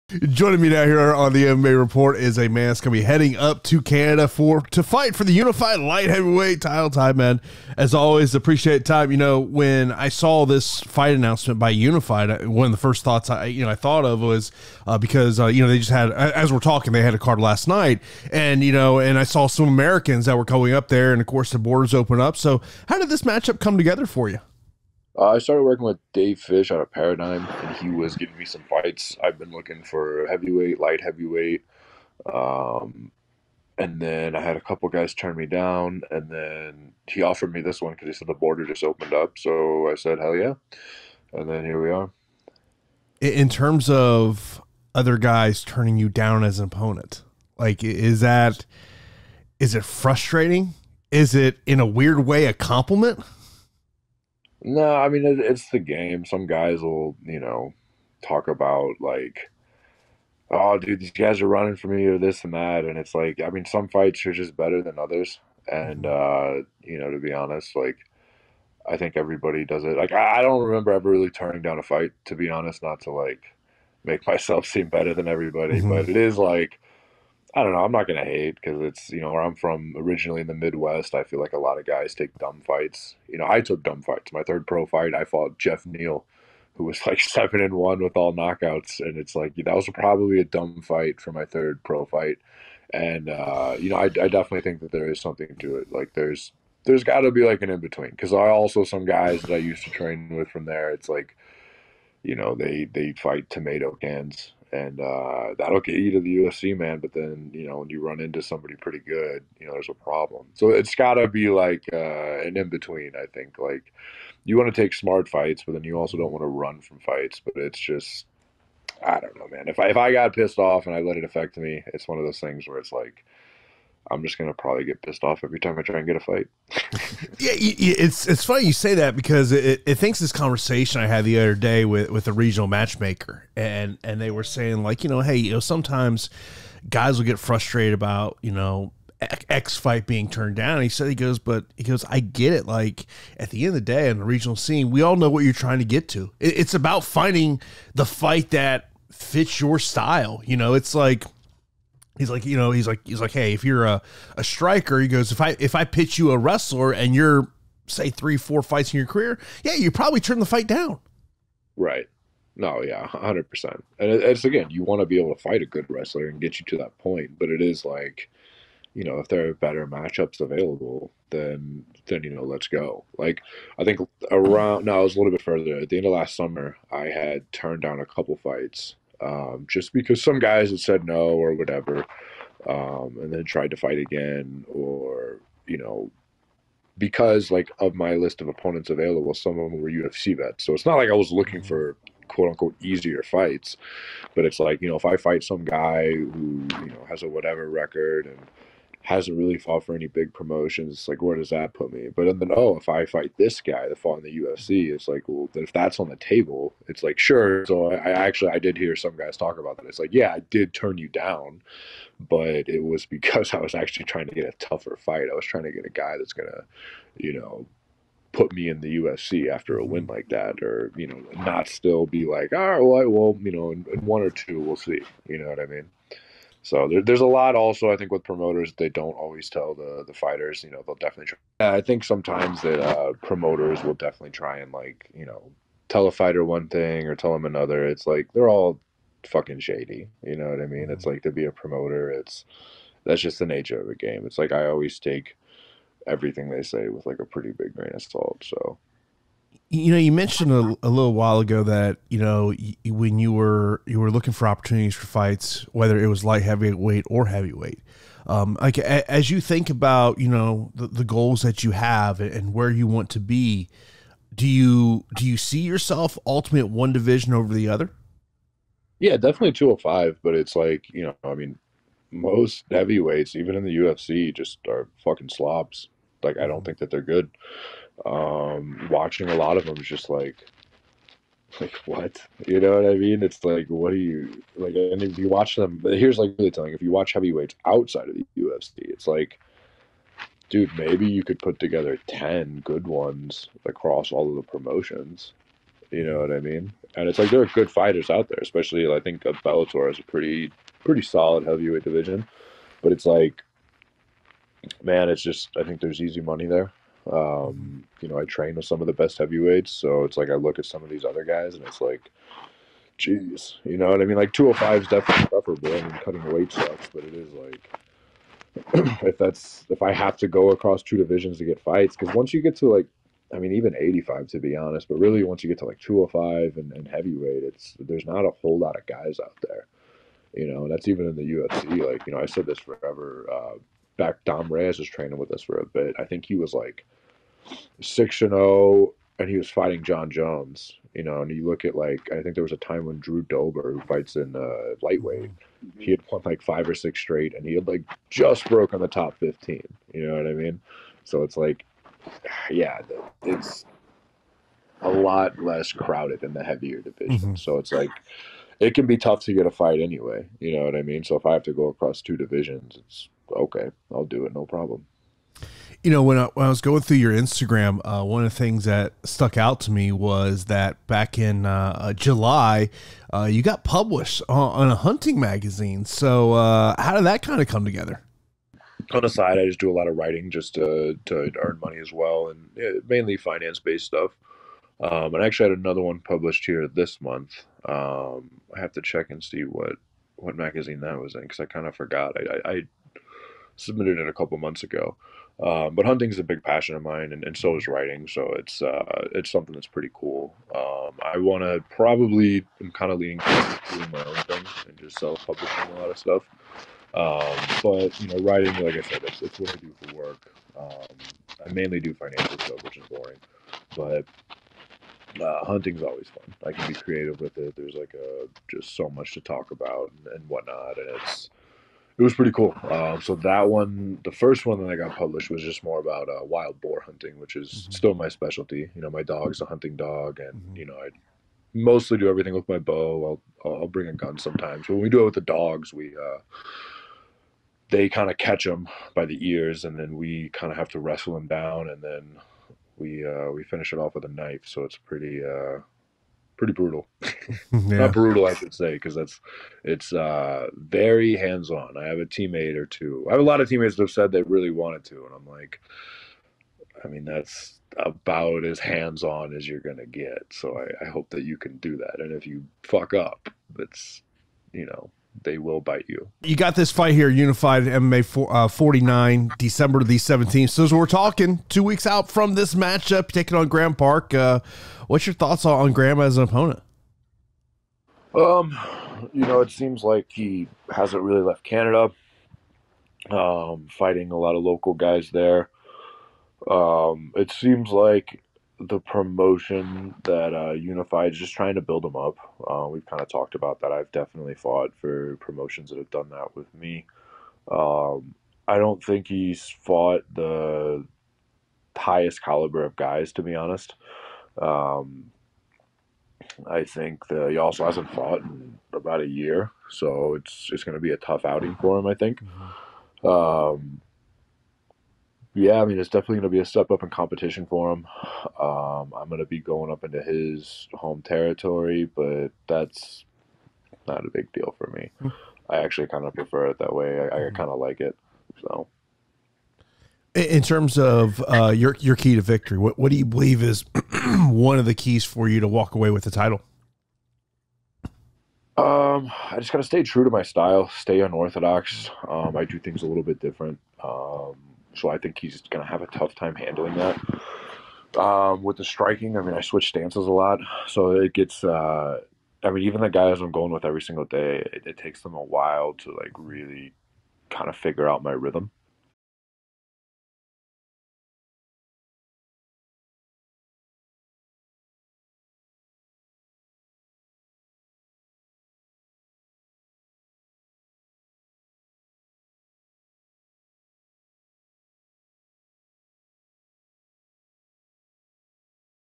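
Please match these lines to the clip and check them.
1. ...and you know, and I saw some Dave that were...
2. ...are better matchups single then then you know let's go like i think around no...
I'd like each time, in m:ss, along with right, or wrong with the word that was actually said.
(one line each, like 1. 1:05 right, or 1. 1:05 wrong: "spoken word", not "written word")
1. 0:18 wrong: "Americans", not "Dave"
2. 2:49 wrong: "available", not "single".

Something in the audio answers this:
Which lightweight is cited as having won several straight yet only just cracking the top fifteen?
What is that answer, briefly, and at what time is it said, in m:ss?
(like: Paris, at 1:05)
Drew Dober, at 5:42.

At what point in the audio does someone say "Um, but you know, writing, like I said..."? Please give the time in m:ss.
6:46.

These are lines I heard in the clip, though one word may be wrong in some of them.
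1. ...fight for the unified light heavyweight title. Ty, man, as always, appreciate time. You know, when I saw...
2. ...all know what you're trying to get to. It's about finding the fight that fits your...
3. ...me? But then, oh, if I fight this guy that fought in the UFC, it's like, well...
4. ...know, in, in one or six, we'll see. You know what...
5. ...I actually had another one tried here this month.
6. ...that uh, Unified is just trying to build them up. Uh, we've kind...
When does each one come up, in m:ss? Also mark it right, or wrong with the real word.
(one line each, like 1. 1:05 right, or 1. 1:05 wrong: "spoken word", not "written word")
1. 0:04 right
2. 2:25 right
3. 3:21 right
4. 3:43 wrong: "two", not "six"
5. 6:25 wrong: "published", not "tried"
6. 8:10 right.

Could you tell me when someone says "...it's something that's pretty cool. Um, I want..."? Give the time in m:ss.
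6:39.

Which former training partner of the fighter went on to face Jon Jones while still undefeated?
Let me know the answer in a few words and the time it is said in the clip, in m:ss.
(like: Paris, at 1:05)
Dom Reyes, at 5:34.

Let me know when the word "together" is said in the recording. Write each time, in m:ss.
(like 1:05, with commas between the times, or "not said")
0:23, 4:51, 6:17.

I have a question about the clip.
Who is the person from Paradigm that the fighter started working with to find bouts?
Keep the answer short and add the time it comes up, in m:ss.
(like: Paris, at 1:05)
Dave Fish, at 0:26.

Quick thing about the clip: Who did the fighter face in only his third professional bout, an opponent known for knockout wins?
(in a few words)
Jeff Neal.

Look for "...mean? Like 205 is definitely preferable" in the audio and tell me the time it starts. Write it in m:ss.
5:14.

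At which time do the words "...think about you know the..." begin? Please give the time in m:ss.
4:19.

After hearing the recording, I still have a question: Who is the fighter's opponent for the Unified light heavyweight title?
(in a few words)
Graham Park.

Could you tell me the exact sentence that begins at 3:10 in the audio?
So it's not like I was looking mm-hmm.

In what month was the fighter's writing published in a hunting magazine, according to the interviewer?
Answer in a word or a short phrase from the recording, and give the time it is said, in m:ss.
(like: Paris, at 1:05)
July, at 6:11.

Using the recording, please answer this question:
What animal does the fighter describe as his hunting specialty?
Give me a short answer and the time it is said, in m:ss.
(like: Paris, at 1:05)
Wild boar, at 7:06.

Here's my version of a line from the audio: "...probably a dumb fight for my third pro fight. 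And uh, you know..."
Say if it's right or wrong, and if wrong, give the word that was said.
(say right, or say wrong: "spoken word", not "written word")
right.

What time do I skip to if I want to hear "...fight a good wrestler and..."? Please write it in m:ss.
2:45.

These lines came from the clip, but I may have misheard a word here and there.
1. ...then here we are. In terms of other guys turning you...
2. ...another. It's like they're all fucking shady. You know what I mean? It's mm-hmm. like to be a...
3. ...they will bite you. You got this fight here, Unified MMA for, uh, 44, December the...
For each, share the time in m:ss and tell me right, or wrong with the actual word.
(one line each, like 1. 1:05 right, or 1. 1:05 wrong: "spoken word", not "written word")
1. 0:41 right
2. 3:57 right
3. 7:45 wrong: "49", not "44".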